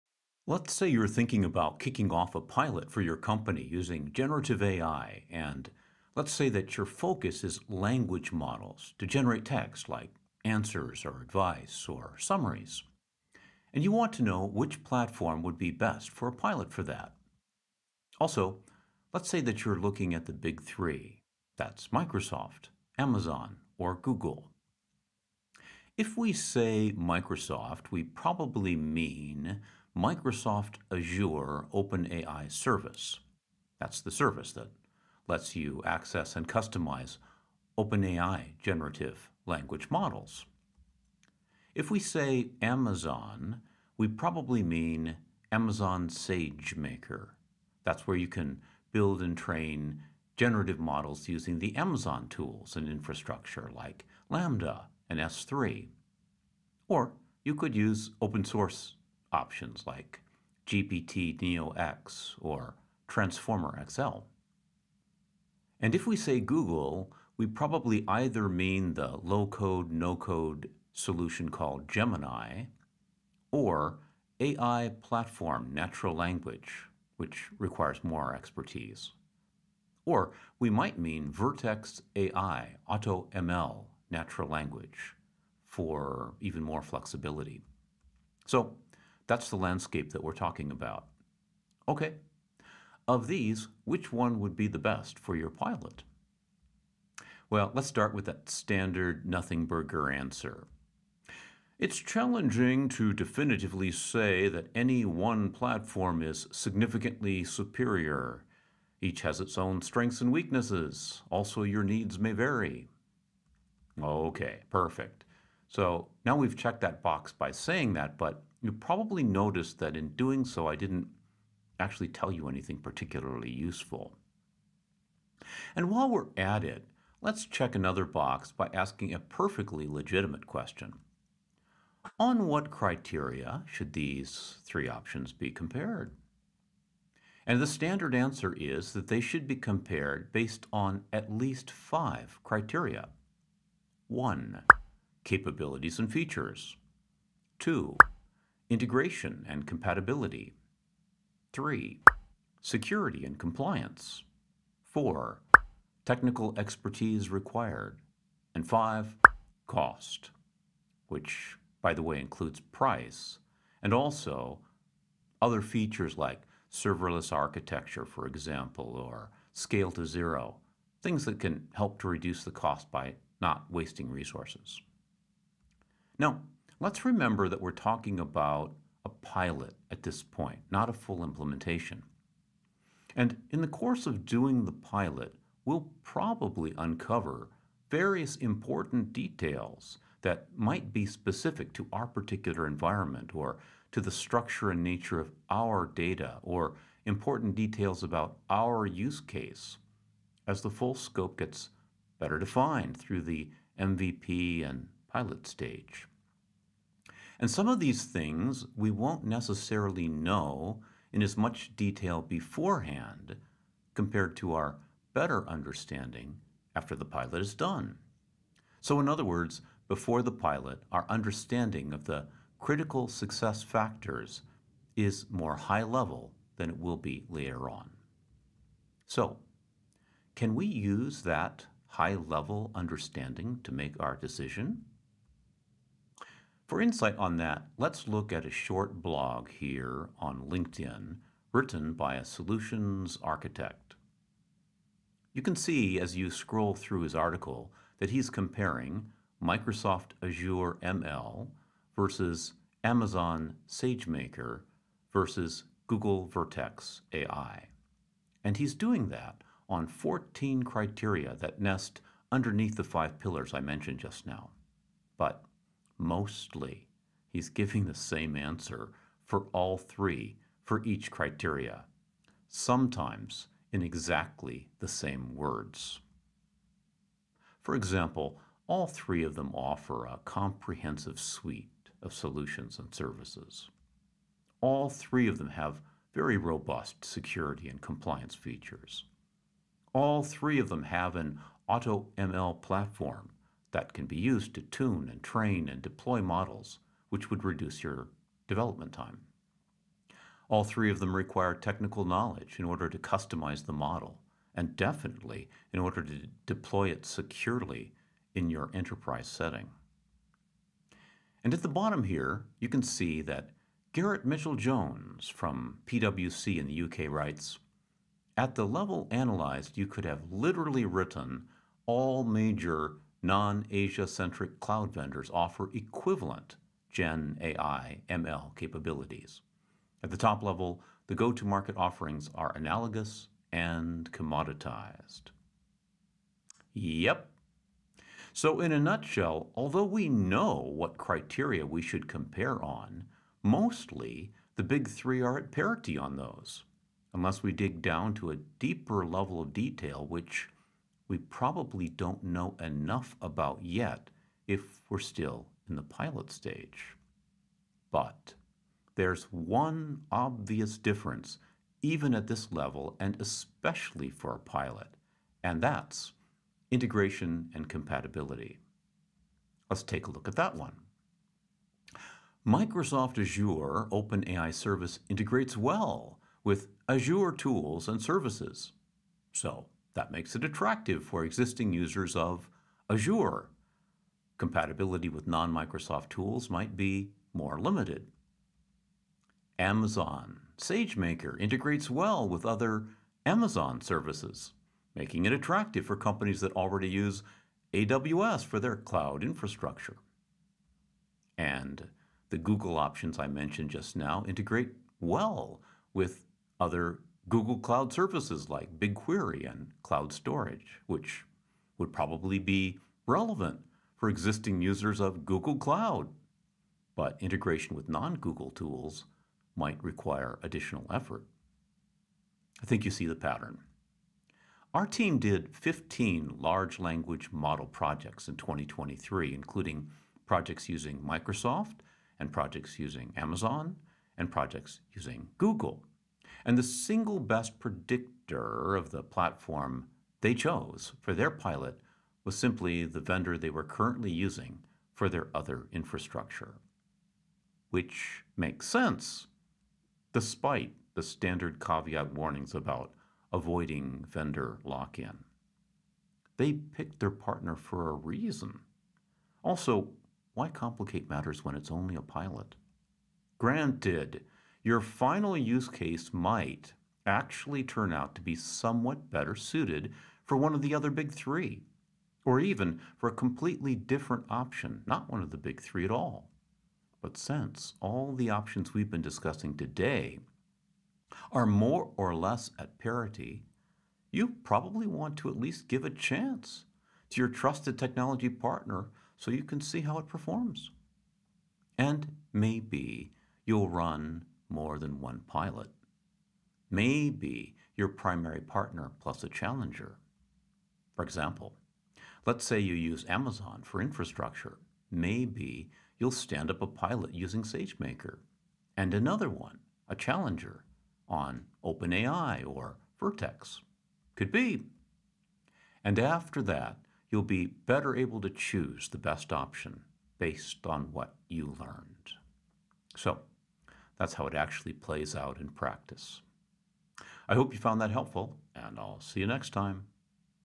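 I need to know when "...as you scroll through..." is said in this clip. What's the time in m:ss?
4:05.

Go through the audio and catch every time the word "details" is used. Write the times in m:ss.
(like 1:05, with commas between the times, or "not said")
3:09, 3:17, 3:31, 5:49.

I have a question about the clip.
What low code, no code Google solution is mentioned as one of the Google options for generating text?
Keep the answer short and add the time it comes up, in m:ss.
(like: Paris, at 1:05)
Gemini, at 1:11.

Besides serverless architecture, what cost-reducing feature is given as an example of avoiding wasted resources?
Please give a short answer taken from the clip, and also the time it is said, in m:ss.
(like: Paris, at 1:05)
scale to zero, at 2:49.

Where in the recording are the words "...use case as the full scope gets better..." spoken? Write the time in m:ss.
3:18.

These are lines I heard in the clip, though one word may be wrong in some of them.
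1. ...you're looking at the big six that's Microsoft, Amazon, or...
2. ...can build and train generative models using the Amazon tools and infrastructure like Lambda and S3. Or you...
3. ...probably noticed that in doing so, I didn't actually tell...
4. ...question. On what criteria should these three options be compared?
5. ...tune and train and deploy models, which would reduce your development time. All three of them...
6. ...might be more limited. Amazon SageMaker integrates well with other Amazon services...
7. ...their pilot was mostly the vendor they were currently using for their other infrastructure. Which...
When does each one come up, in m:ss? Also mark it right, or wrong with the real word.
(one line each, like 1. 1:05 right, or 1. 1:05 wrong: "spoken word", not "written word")
1. 0:19 wrong: "three", not "six"
2. 0:48 right
3. 1:58 right
4. 2:10 right
5. 4:54 right
6. 6:26 right
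7. 7:21 wrong: "simply", not "mostly".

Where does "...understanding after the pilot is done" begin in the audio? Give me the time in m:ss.
3:35.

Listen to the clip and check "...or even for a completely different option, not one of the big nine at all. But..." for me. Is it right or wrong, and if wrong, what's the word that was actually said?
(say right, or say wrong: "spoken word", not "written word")
wrong: "three", not "nine".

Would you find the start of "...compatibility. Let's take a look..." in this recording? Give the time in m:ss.
6:07.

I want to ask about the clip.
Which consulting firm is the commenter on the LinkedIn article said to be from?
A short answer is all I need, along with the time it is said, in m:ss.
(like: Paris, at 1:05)
PwC, at 5:15.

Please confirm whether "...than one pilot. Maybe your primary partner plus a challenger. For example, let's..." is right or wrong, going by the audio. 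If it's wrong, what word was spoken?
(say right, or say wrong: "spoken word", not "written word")
right.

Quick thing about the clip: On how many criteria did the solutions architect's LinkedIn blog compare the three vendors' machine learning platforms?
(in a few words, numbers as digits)
14.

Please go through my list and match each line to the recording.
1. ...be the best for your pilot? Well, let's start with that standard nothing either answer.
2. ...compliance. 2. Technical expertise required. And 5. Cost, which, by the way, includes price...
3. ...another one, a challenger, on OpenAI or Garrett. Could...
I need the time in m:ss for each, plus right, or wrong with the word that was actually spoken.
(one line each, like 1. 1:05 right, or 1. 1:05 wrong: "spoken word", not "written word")
1. 1:34 wrong: "burger", not "either"
2. 2:33 wrong: "4", not "2"
3. 8:28 wrong: "Vertex", not "Garrett".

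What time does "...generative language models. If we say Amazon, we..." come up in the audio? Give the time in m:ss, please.
0:38.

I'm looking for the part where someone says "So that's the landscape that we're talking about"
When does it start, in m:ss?
1:28.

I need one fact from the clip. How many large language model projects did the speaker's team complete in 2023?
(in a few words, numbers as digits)
15.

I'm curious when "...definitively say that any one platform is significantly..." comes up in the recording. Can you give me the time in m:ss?
1:43.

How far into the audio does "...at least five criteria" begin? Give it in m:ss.
2:21.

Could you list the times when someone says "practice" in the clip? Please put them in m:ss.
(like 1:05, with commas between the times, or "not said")
8:45.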